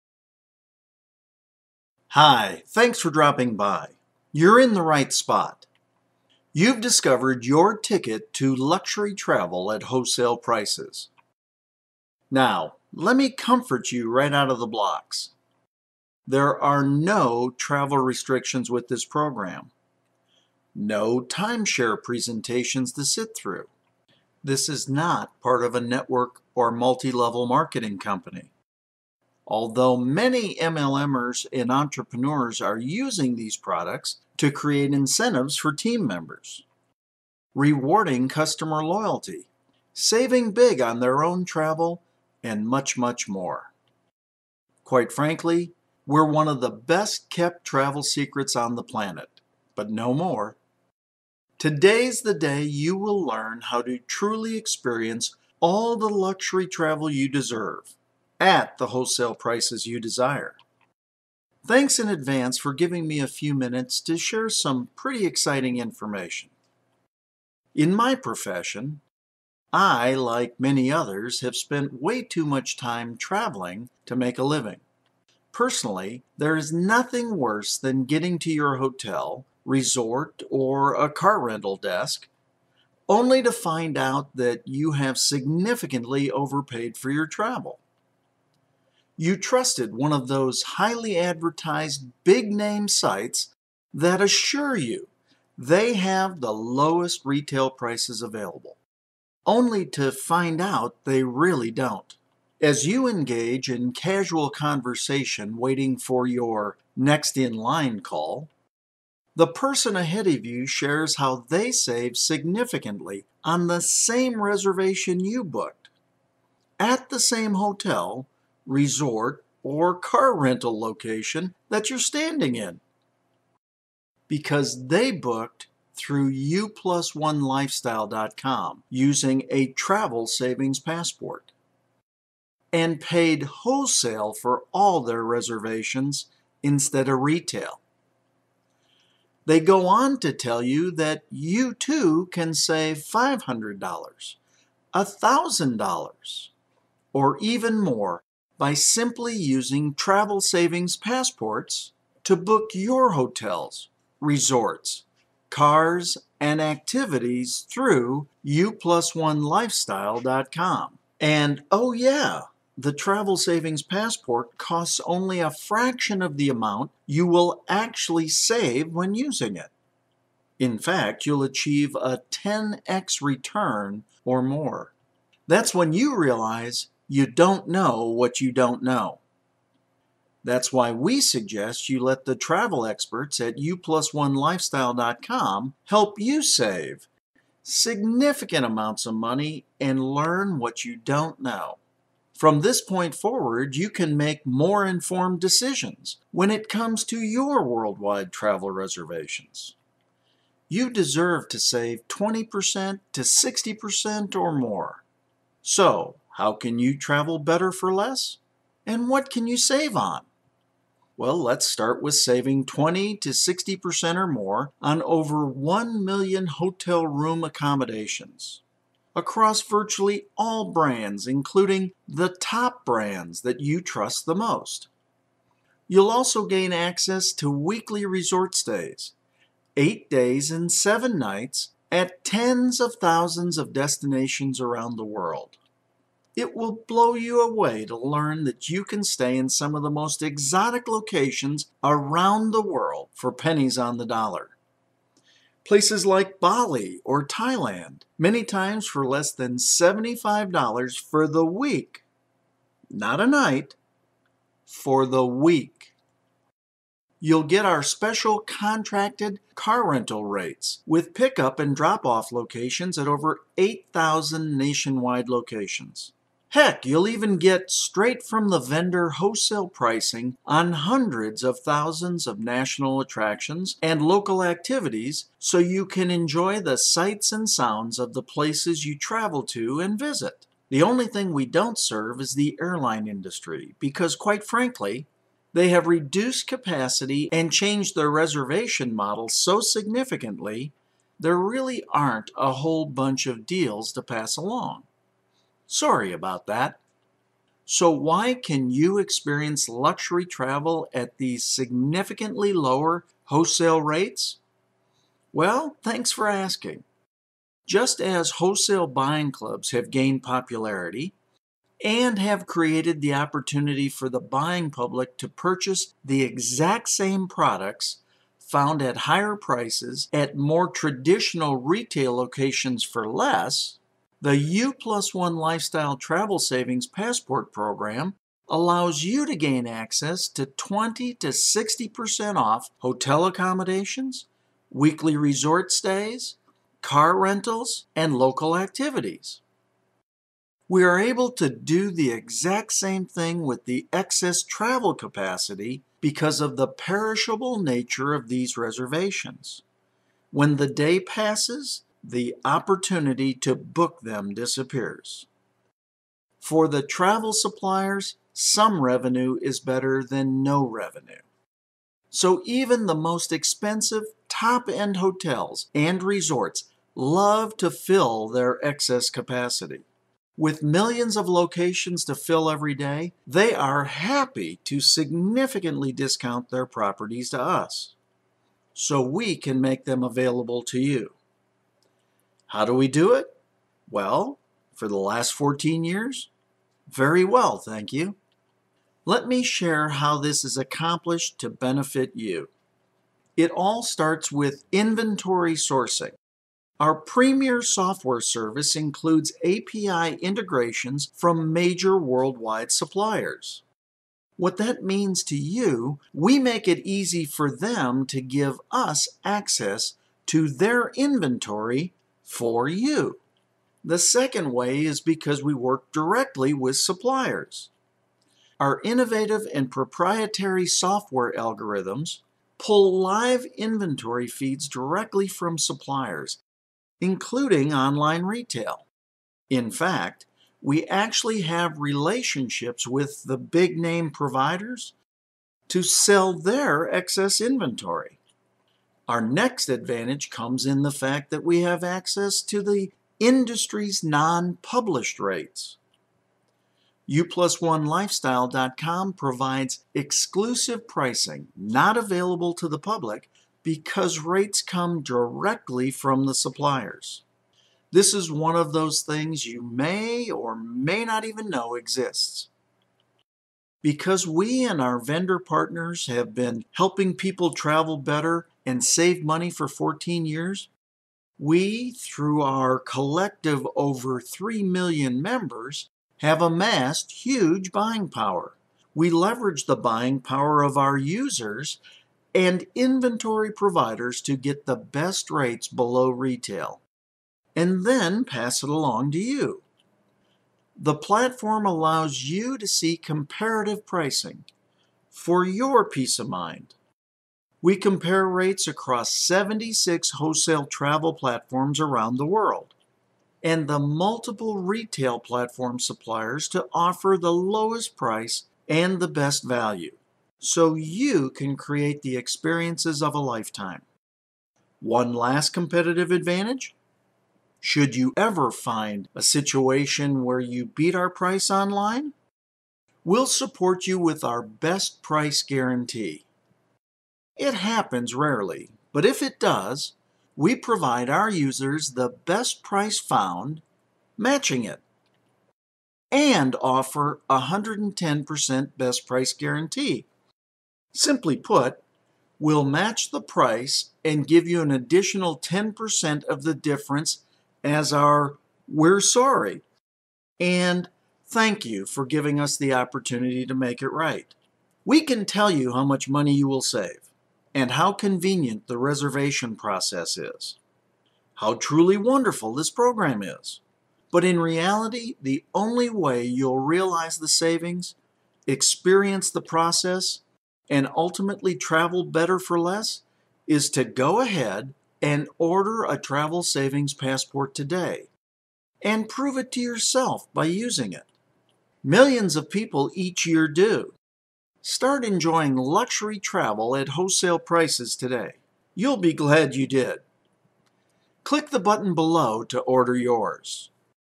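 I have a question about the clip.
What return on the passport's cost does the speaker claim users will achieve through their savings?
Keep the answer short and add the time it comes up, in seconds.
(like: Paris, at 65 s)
10x, at 172 s.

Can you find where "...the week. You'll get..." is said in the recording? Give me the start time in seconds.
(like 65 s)
255 s.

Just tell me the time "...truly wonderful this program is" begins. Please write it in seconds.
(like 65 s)
561 s.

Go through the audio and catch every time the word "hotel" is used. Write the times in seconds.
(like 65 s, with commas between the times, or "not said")
78 s, 117 s, 153 s, 216 s, 332 s, 364 s.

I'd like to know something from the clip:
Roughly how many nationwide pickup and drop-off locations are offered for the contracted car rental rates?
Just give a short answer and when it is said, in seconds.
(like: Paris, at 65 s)
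over 8,000, at 263 s.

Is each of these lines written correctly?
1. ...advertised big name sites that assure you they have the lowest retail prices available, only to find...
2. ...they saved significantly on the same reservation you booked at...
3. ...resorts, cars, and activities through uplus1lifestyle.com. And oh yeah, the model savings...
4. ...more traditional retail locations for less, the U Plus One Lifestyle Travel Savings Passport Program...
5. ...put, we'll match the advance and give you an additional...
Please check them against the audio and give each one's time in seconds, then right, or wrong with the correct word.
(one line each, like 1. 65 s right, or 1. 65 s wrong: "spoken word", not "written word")
1. 91 s right
2. 111 s right
3. 154 s wrong: "travel", not "model"
4. 320 s right
5. 541 s wrong: "price", not "advance".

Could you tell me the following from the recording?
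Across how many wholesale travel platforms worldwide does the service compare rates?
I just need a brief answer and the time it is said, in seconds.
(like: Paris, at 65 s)
76, at 499 s.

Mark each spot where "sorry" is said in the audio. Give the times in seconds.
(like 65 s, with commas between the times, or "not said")
295 s, 549 s.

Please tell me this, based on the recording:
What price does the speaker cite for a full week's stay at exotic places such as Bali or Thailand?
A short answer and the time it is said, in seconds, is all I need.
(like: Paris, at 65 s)
less than $75, at 249 s.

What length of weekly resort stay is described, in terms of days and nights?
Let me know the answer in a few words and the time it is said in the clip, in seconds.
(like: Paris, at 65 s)
8 days and 7 nights, at 229 s.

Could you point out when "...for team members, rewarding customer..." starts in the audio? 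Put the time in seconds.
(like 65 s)
35 s.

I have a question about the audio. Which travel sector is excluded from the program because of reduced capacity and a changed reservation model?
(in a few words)
the airline industry.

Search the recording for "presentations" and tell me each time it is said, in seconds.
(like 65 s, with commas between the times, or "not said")
22 s.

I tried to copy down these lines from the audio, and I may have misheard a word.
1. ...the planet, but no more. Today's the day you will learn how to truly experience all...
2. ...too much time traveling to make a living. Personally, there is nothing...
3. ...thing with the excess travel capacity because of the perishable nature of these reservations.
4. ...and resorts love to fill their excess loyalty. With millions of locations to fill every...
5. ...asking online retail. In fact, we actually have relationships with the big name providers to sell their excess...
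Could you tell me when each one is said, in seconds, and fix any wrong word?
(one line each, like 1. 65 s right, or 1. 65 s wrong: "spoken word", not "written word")
1. 48 s right
2. 72 s right
3. 343 s right
4. 365 s wrong: "capacity", not "loyalty"
5. 427 s wrong: "including", not "asking".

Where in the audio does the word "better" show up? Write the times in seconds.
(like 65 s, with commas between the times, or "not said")
207 s, 359 s, 467 s, 572 s.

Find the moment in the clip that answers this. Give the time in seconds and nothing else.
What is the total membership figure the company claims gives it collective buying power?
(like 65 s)
473 s.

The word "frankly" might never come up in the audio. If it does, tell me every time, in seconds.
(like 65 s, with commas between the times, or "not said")
45 s, 284 s.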